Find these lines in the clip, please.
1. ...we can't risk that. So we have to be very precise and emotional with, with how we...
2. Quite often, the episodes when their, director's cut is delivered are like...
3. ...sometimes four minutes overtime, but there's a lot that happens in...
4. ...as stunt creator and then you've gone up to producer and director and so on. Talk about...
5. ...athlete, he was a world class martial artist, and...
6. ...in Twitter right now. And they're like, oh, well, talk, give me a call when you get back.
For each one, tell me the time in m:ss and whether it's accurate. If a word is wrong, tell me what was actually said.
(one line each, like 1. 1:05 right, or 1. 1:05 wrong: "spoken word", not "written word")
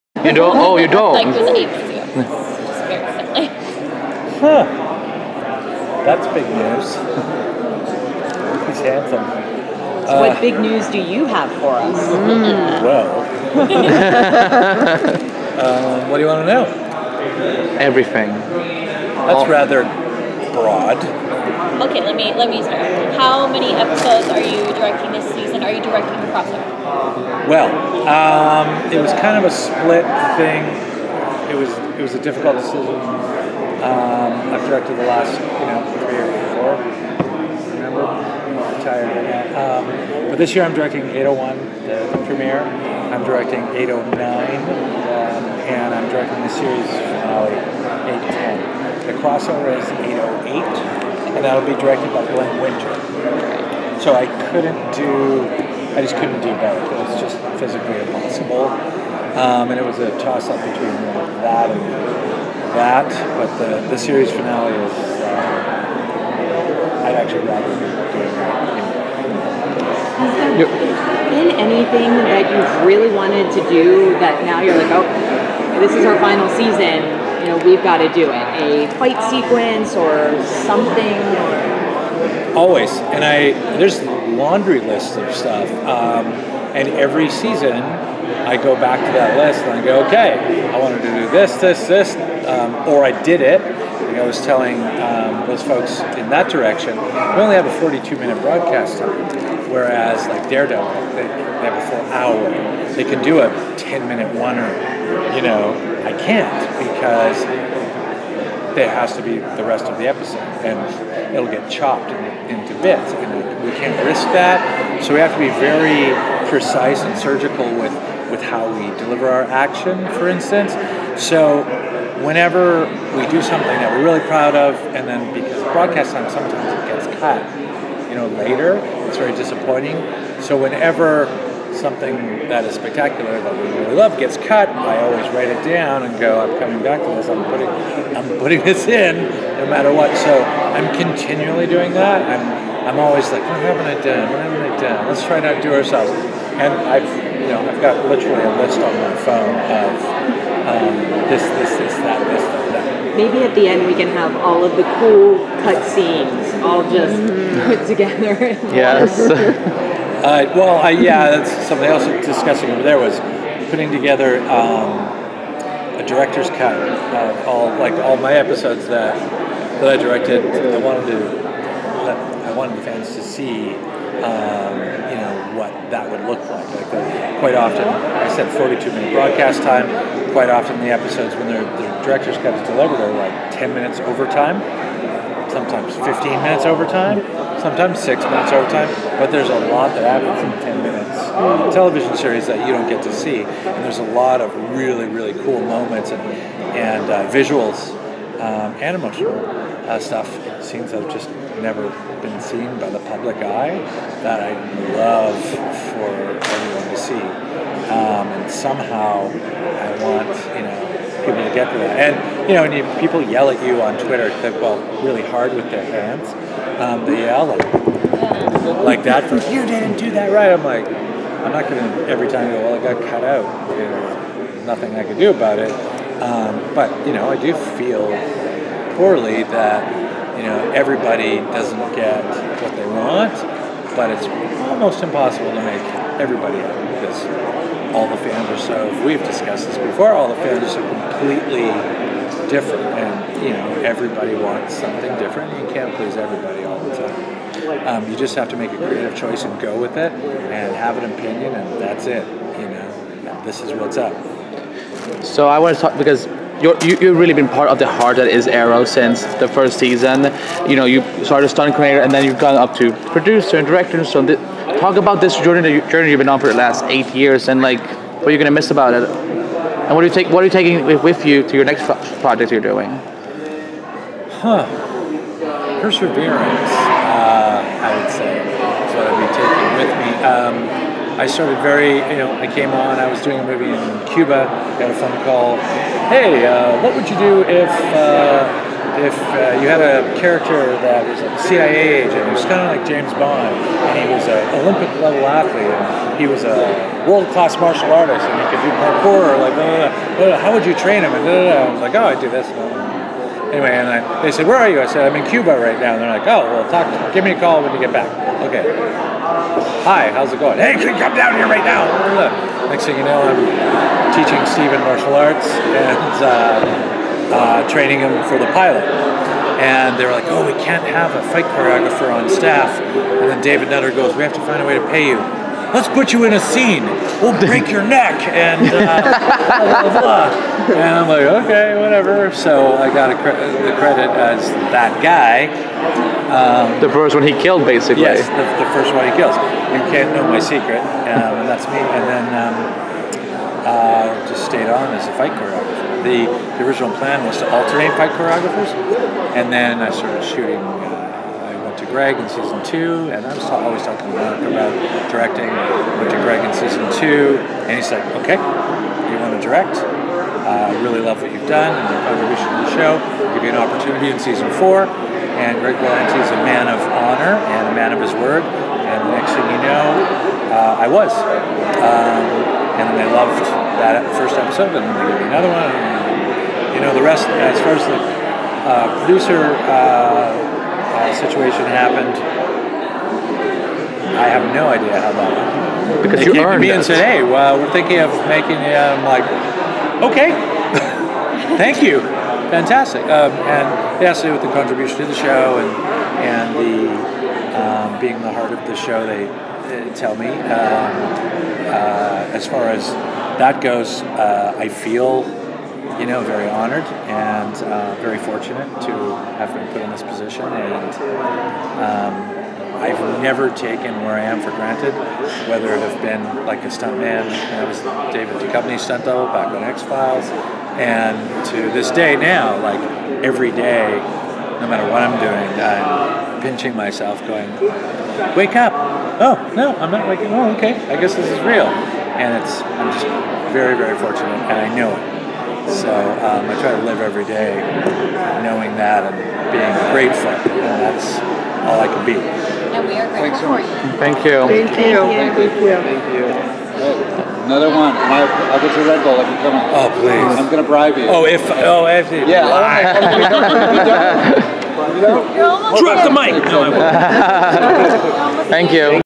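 1. 1:53 wrong: "surgical", not "emotional"
2. 3:00 right
3. 3:07 wrong: "six", not "four"
4. 4:21 right
5. 4:55 right
6. 5:05 wrong: "Cuba", not "Twitter".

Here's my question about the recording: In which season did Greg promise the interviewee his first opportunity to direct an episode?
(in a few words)
Season 4.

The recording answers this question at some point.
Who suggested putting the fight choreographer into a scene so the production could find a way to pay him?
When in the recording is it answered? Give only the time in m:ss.
5:23.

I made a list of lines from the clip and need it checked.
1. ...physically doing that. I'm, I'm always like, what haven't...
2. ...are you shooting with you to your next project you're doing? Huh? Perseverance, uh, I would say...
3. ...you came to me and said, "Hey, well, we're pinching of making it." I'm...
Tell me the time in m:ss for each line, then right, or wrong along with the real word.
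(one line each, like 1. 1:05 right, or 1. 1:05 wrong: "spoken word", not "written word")
1. 2:20 wrong: "continually", not "physically"
2. 4:30 wrong: "taking", not "shooting"
3. 6:26 wrong: "thinking", not "pinching".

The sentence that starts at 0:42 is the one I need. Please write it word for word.
I'm directing 809, um, and I'm directing the series finale 810.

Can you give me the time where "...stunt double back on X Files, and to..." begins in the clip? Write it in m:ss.
6:58.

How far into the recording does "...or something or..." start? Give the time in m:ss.
1:19.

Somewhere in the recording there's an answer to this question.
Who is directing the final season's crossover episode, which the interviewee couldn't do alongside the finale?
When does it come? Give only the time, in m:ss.
0:52.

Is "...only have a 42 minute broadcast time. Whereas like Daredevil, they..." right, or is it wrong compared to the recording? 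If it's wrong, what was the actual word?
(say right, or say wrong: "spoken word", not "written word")
right.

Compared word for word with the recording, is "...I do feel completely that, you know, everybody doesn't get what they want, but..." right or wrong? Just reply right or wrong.
wrong.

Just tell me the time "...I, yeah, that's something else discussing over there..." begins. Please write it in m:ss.
2:40.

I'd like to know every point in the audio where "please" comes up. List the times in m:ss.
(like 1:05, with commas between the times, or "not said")
4:05, 7:29.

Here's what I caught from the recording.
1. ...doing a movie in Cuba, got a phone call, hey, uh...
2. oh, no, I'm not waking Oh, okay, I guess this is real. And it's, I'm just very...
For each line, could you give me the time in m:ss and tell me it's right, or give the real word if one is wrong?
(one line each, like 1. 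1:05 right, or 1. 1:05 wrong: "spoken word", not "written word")
1. 4:43 right
2. 7:09 right.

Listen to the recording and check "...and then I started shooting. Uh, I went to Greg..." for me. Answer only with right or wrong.
right.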